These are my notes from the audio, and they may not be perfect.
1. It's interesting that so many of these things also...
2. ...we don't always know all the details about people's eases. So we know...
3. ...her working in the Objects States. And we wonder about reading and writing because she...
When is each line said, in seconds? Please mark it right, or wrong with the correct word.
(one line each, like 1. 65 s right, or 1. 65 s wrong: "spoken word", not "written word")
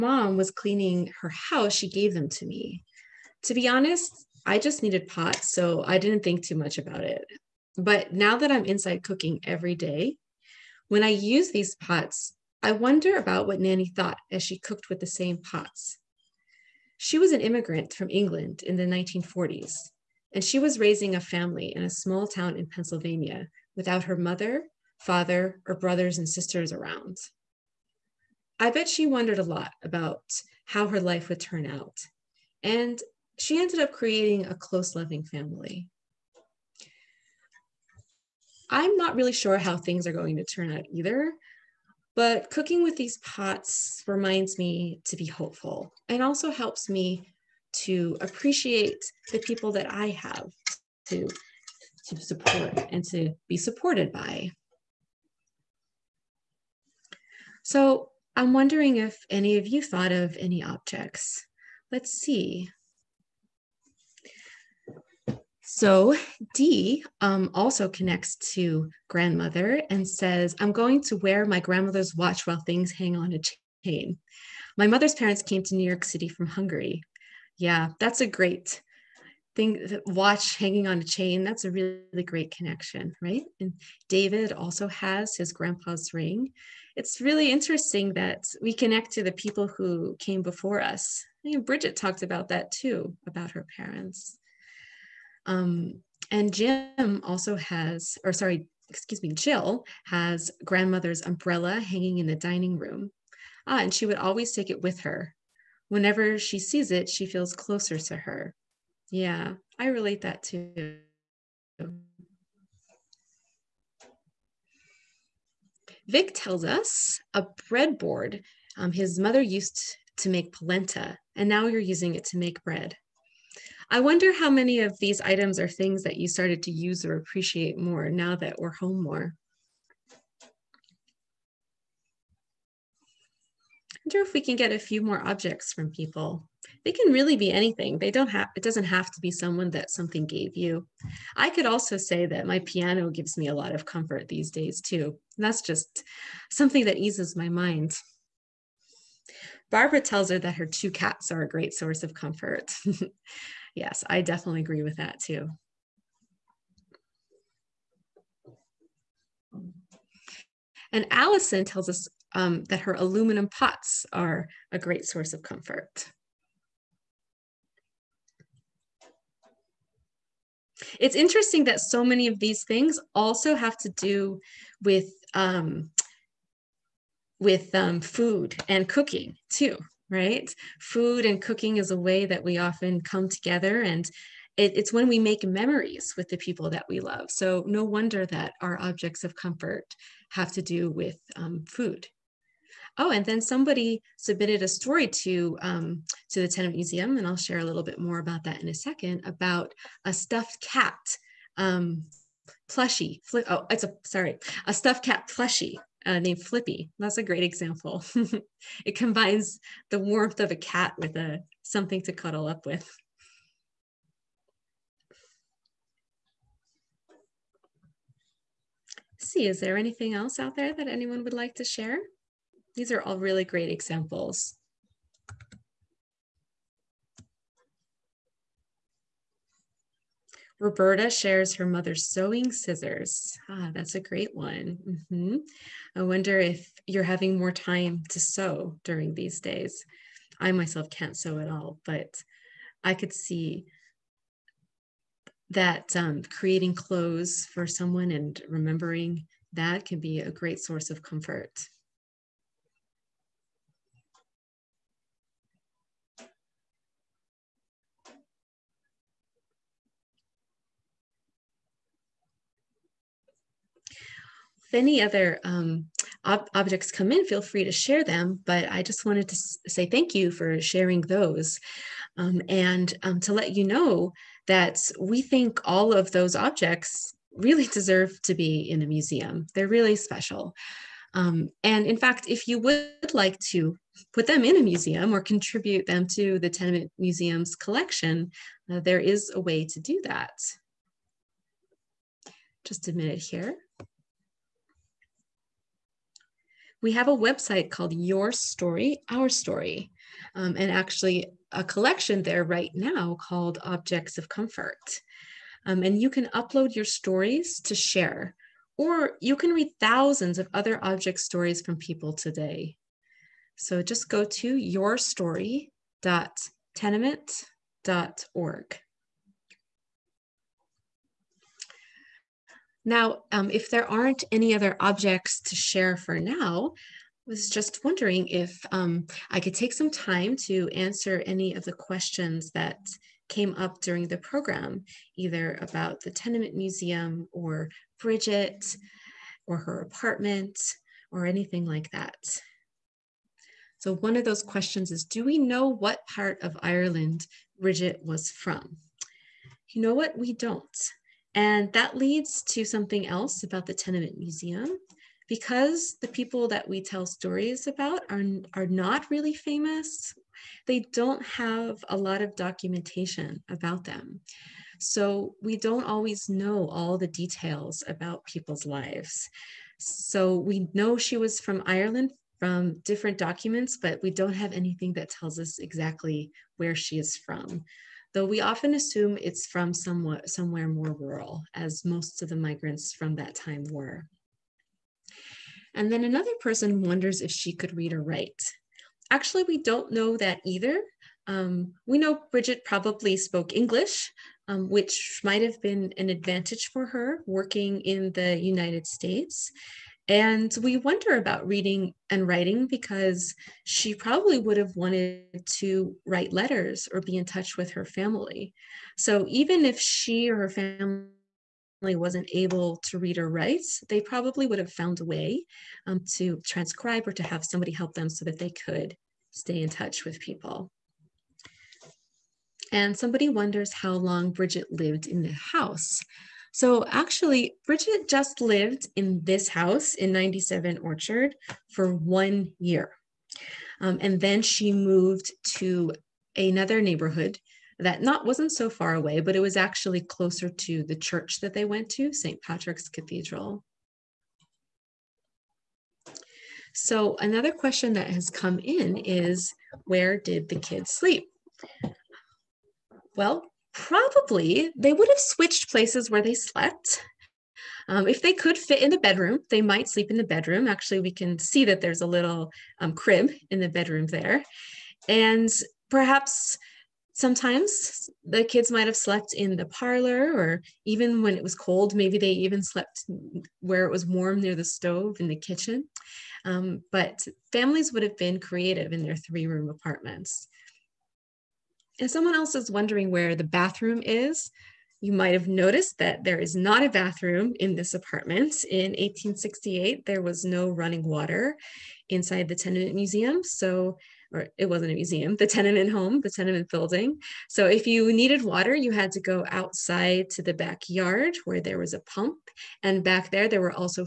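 1. 170 s right
2. 365 s wrong: "lives", not "eases"
3. 396 s wrong: "United", not "Objects".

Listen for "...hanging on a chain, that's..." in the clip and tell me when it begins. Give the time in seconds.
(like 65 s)
80 s.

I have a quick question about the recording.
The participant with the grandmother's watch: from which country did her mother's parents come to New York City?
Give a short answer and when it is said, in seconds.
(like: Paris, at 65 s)
Hungary, at 76 s.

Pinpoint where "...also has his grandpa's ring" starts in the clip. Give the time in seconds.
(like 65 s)
84 s.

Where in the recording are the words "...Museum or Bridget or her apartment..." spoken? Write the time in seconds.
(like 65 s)
336 s.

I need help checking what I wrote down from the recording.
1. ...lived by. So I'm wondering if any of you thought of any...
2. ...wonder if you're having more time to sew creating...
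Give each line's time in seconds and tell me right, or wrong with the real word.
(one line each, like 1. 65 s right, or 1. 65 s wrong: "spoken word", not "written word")
1. 53 s wrong: "supported", not "lived"
2. 236 s wrong: "during", not "creating".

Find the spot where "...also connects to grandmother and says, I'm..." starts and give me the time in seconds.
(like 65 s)
67 s.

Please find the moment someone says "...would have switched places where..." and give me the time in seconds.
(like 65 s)
454 s.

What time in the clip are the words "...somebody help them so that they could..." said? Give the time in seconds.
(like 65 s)
417 s.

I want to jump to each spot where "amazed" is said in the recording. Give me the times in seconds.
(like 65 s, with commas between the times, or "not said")
not said.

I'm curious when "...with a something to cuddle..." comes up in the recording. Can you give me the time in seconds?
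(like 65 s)
210 s.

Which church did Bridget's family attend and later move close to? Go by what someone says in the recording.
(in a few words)
St. Patrick's Cathedral.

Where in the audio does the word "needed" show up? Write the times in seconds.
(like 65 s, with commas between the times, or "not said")
4 s, 498 s.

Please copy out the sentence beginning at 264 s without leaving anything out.
if any other um, ob objects come in, feel free to share them.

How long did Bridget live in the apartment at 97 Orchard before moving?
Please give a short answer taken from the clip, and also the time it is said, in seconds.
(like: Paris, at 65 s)
1 year, at 431 s.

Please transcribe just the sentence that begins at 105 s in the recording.
Whenever she sees it, she feels closer to her.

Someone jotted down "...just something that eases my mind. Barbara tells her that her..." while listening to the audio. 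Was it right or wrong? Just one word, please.
right.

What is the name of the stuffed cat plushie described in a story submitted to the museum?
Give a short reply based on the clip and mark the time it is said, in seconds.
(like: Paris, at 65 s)
Flippy, at 206 s.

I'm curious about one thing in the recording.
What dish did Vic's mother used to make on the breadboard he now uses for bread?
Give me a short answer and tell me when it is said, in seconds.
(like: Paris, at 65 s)
Polenta, at 120 s.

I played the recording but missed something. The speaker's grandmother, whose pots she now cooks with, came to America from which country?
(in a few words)
England.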